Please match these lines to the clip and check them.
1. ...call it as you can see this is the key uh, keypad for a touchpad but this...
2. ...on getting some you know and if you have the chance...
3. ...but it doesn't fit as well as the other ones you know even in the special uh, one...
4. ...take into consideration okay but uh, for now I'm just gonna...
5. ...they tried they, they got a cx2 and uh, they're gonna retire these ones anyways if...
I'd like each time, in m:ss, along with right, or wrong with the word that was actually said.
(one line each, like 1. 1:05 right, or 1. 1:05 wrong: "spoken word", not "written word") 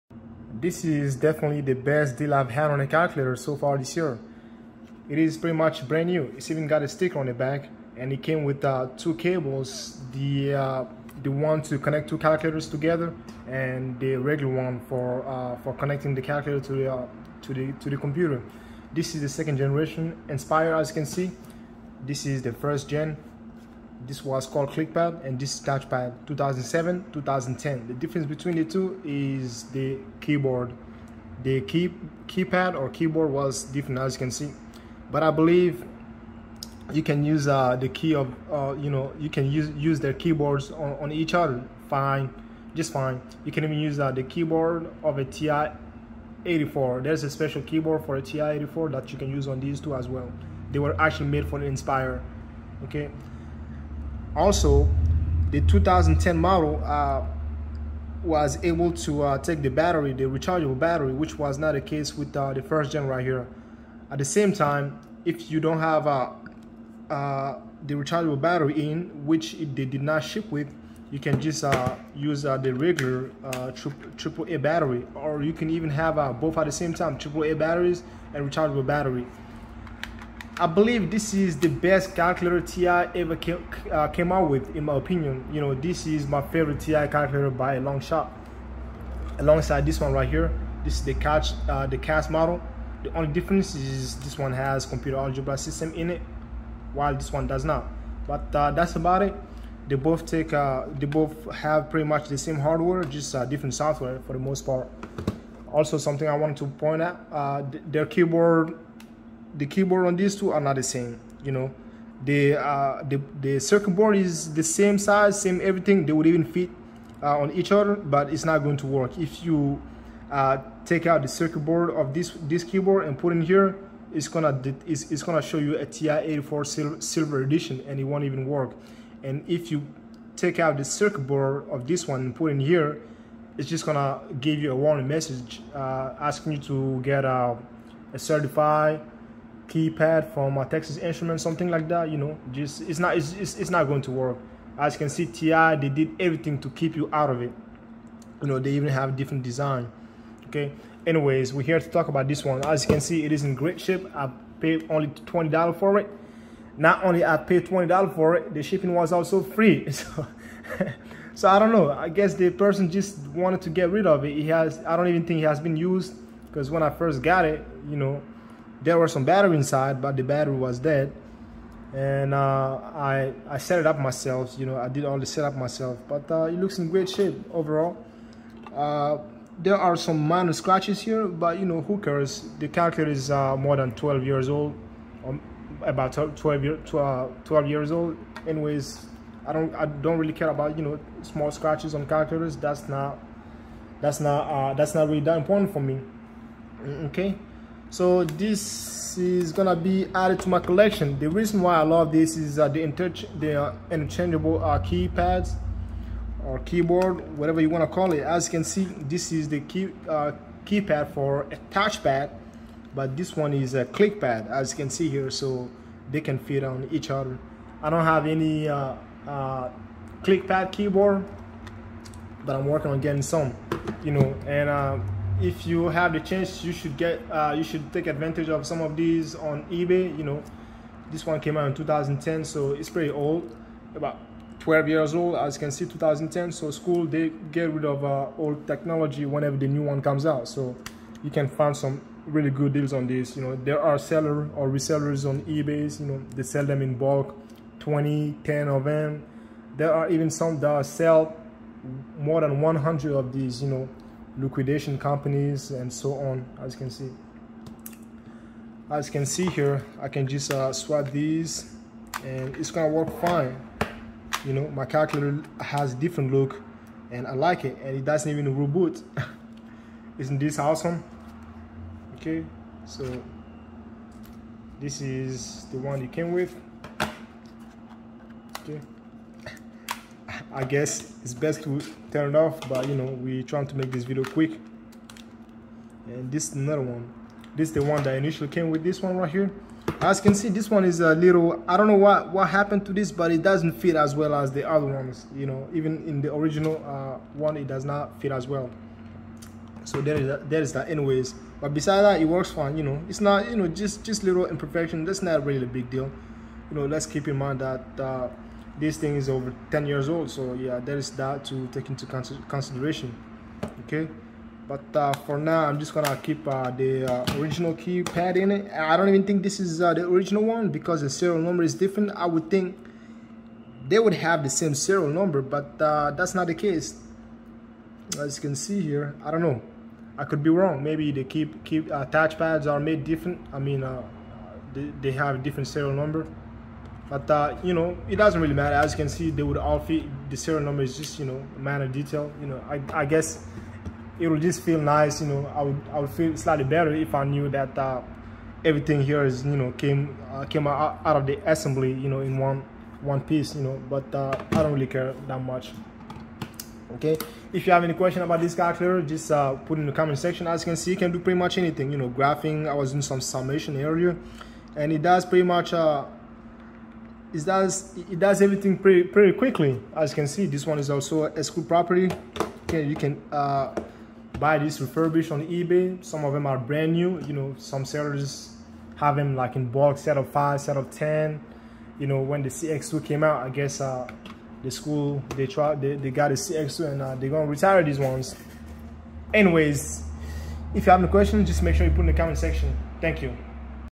1. 3:27 right
2. 3:42 right
3. 4:53 wrong: "original", not "special"
4. 5:11 right
5. 6:25 right.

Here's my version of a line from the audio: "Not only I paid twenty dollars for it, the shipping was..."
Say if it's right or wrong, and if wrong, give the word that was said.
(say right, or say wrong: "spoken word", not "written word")
right.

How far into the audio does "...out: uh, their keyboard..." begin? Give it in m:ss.
1:47.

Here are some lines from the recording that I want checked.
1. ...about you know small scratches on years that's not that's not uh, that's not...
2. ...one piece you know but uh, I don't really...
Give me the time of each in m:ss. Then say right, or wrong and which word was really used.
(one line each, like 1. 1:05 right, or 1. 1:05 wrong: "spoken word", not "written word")
1. 3:10 wrong: "calculators", not "years"
2. 5:53 right.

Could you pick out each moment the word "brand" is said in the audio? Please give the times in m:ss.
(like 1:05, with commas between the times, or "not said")
0:05, 6:16.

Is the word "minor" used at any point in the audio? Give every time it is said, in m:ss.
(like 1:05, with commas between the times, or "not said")
3:00, 5:41.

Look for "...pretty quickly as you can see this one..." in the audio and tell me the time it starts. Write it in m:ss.
6:09.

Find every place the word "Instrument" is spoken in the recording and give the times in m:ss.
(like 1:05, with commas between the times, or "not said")
2:20.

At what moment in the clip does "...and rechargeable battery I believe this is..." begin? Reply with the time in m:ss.
1:18.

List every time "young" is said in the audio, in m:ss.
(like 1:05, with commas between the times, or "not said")
not said.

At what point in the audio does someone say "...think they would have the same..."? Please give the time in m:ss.
5:22.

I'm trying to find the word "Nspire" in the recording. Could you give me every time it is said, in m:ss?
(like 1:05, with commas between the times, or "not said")
0:20, 0:51.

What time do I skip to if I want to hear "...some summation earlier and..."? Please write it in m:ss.
6:03.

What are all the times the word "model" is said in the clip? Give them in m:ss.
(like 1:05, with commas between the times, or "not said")
0:56, 1:32.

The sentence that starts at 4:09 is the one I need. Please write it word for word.
There are even some that sell more than 100 of these.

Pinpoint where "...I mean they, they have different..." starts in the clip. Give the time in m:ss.
5:33.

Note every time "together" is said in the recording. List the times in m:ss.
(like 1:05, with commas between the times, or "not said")
0:12.